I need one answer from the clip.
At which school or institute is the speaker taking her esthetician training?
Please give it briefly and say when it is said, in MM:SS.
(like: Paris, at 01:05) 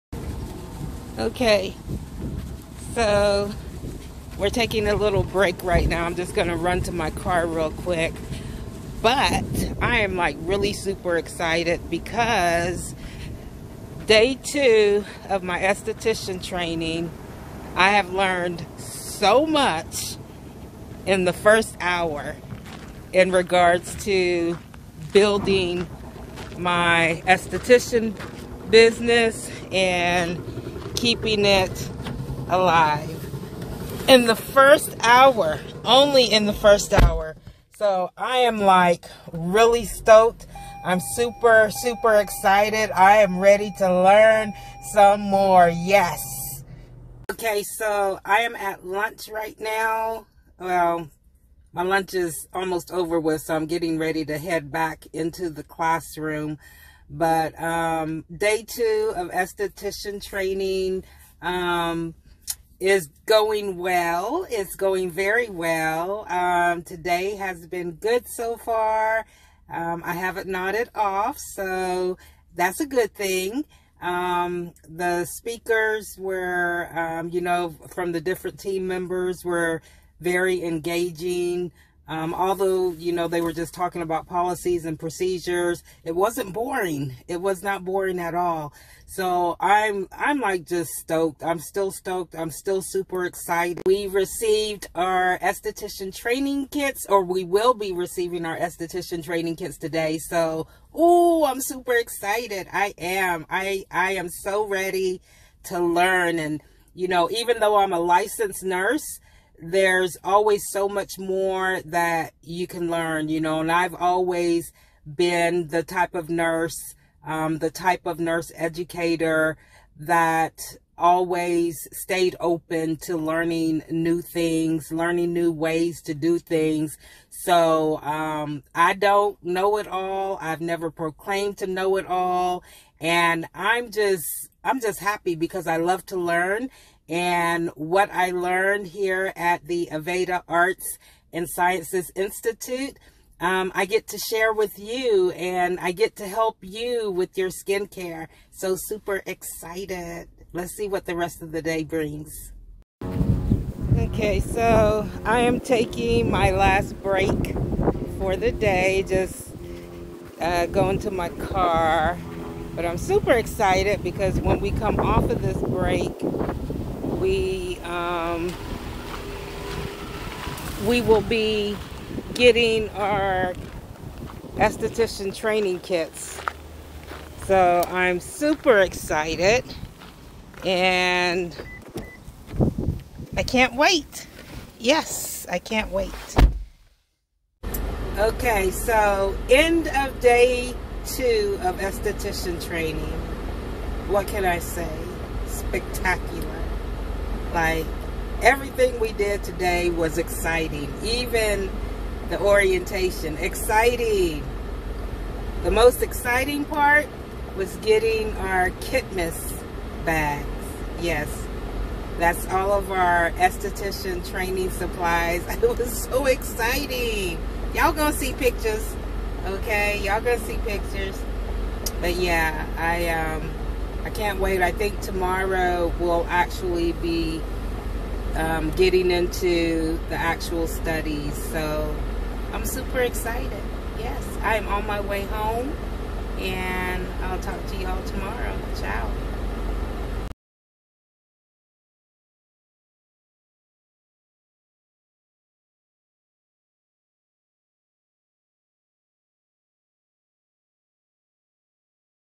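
Aveda Arts and Sciences Institute, at 02:19.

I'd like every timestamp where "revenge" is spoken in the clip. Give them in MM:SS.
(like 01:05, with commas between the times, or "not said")
not said.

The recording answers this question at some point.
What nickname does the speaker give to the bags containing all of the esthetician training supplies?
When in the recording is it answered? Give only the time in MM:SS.
03:28.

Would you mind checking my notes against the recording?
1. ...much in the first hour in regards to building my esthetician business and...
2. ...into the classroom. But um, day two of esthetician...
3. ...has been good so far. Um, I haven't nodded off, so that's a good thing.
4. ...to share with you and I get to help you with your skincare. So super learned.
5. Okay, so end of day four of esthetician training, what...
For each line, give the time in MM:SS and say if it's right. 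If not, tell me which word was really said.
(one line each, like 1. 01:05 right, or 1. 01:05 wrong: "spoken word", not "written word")
1. 00:19 right
2. 00:55 right
3. 01:07 right
4. 02:24 wrong: "excited", not "learned"
5. 03:08 wrong: "two", not "four".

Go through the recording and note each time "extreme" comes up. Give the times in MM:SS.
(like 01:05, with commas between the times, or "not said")
not said.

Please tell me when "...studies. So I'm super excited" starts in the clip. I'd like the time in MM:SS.
03:50.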